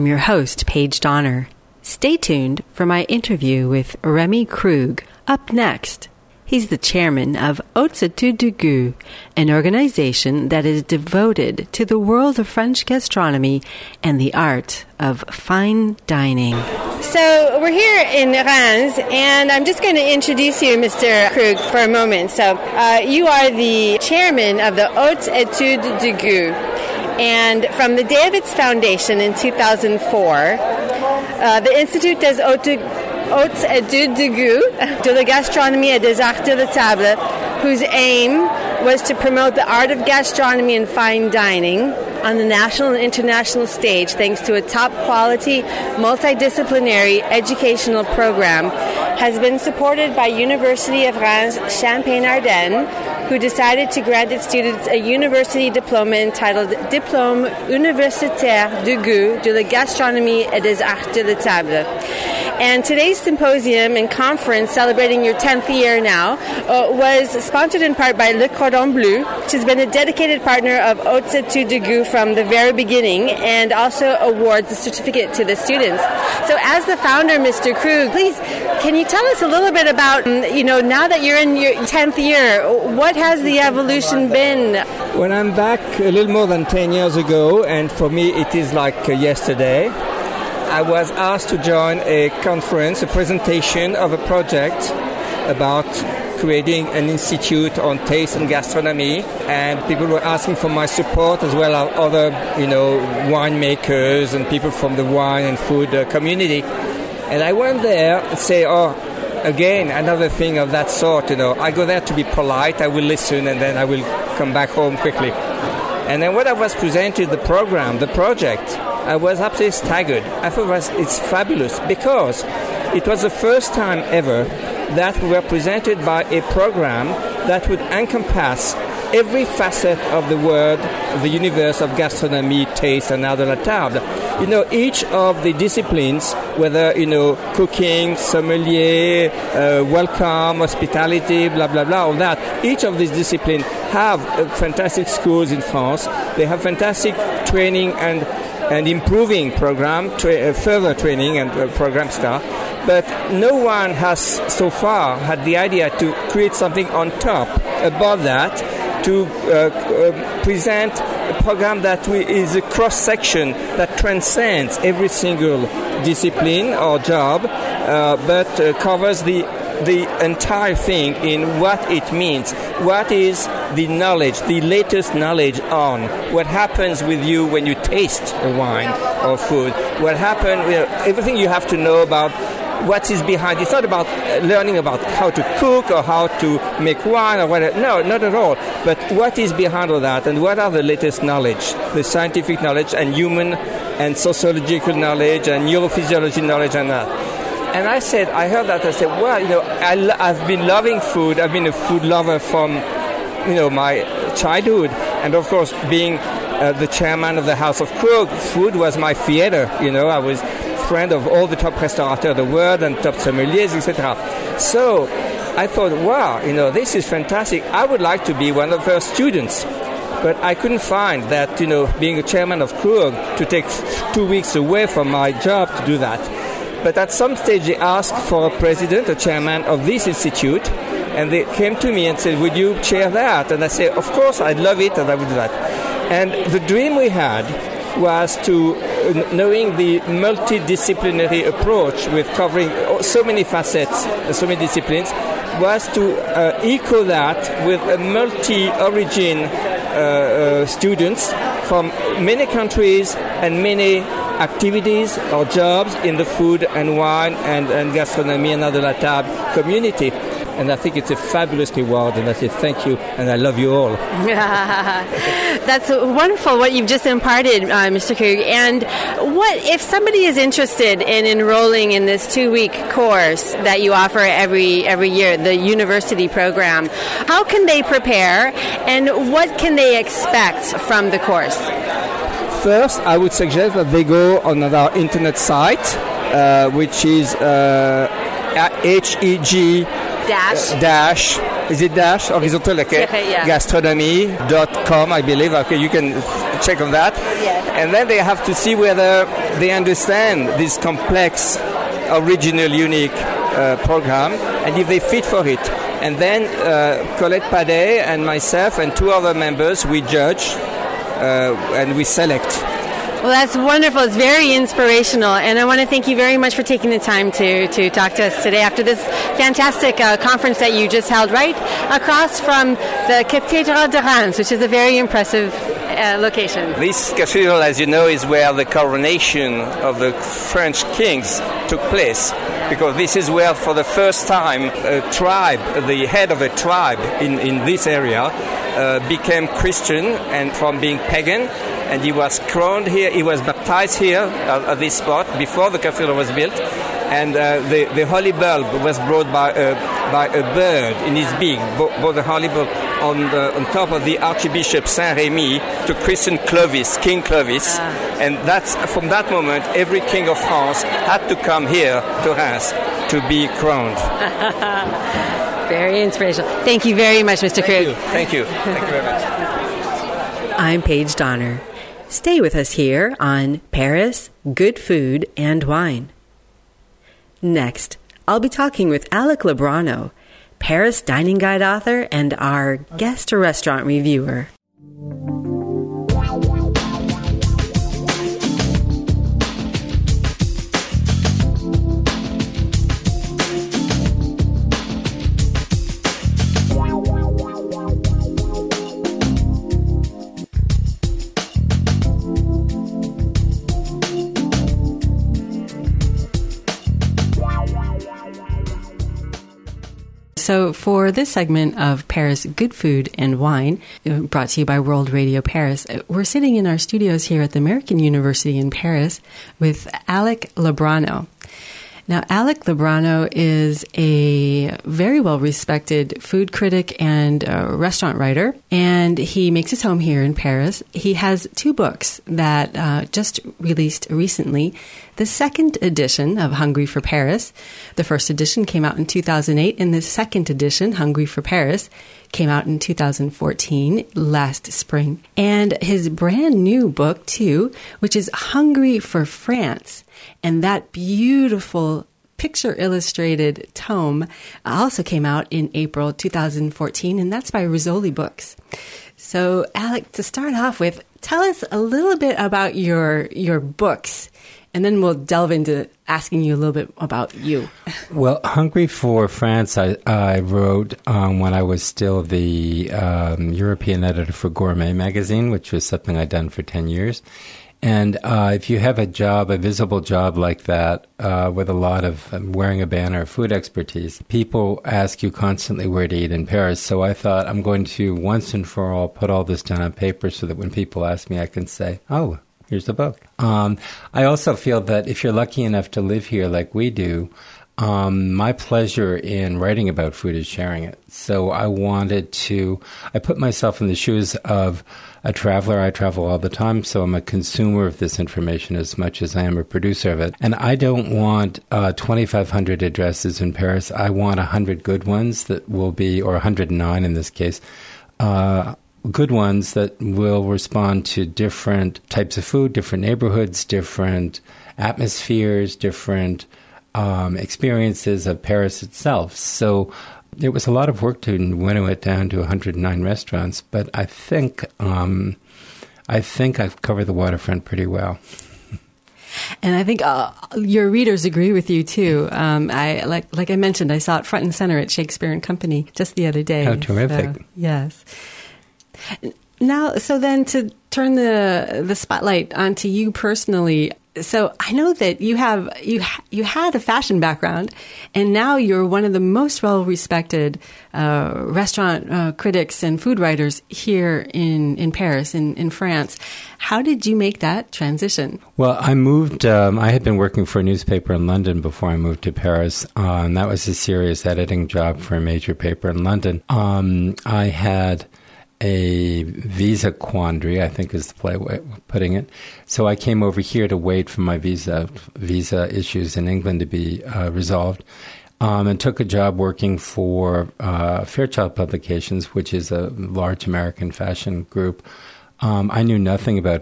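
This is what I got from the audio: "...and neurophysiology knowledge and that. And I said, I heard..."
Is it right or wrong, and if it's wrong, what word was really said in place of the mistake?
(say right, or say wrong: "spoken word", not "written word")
right.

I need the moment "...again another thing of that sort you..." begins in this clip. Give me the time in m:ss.
1:49.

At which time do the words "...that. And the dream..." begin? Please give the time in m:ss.
3:55.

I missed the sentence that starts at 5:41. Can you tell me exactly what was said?
And he was crowned here, he was baptized here at this spot before the cathedral was built.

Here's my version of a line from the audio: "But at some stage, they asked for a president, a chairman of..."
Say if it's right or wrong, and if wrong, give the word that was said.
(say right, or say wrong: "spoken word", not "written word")
right.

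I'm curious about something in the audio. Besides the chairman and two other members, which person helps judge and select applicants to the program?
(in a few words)
Colette Padet.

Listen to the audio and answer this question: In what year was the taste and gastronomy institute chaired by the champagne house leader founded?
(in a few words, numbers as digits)
2004.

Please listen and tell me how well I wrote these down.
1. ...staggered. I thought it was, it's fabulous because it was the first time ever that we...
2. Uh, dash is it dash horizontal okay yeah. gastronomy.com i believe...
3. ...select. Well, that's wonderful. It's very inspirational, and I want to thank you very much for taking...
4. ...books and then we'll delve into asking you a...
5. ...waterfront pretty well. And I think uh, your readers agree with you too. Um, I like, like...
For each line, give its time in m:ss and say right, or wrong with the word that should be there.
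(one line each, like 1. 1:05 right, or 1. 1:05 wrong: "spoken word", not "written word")
1. 1:59 right
2. 4:50 right
3. 5:12 right
4. 7:43 right
5. 8:57 right.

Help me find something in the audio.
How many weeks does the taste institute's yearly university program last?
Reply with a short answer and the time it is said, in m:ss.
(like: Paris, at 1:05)
2 weeks, at 4:32.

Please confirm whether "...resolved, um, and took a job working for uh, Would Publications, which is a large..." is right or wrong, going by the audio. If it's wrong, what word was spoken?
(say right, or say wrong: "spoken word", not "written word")
wrong: "Fairchild", not "Would".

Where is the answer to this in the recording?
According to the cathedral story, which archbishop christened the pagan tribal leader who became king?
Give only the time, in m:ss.
5:54.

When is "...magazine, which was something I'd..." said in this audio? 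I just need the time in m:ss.
7:54.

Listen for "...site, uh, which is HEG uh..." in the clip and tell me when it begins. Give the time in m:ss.
4:45.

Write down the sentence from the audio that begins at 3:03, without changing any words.
It's not about learning about how to cook or how to make wine or whatever.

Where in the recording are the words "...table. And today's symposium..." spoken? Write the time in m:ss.
1:01.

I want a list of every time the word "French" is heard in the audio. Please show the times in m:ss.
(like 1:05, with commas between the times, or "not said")
0:12, 5:30.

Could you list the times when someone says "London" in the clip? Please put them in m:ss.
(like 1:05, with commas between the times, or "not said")
9:31, 9:36.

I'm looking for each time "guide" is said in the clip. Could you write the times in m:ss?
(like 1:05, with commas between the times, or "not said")
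6:21.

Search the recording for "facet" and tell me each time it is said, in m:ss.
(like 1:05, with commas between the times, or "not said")
2:09, 4:03.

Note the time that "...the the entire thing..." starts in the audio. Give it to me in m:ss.
2:49.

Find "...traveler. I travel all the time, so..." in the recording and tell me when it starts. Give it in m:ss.
8:25.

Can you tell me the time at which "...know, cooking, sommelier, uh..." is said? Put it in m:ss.
2:17.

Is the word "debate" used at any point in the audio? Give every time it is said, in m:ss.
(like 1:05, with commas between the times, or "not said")
not said.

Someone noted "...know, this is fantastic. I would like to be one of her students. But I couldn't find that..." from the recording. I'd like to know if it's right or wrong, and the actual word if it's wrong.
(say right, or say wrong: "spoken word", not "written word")
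right.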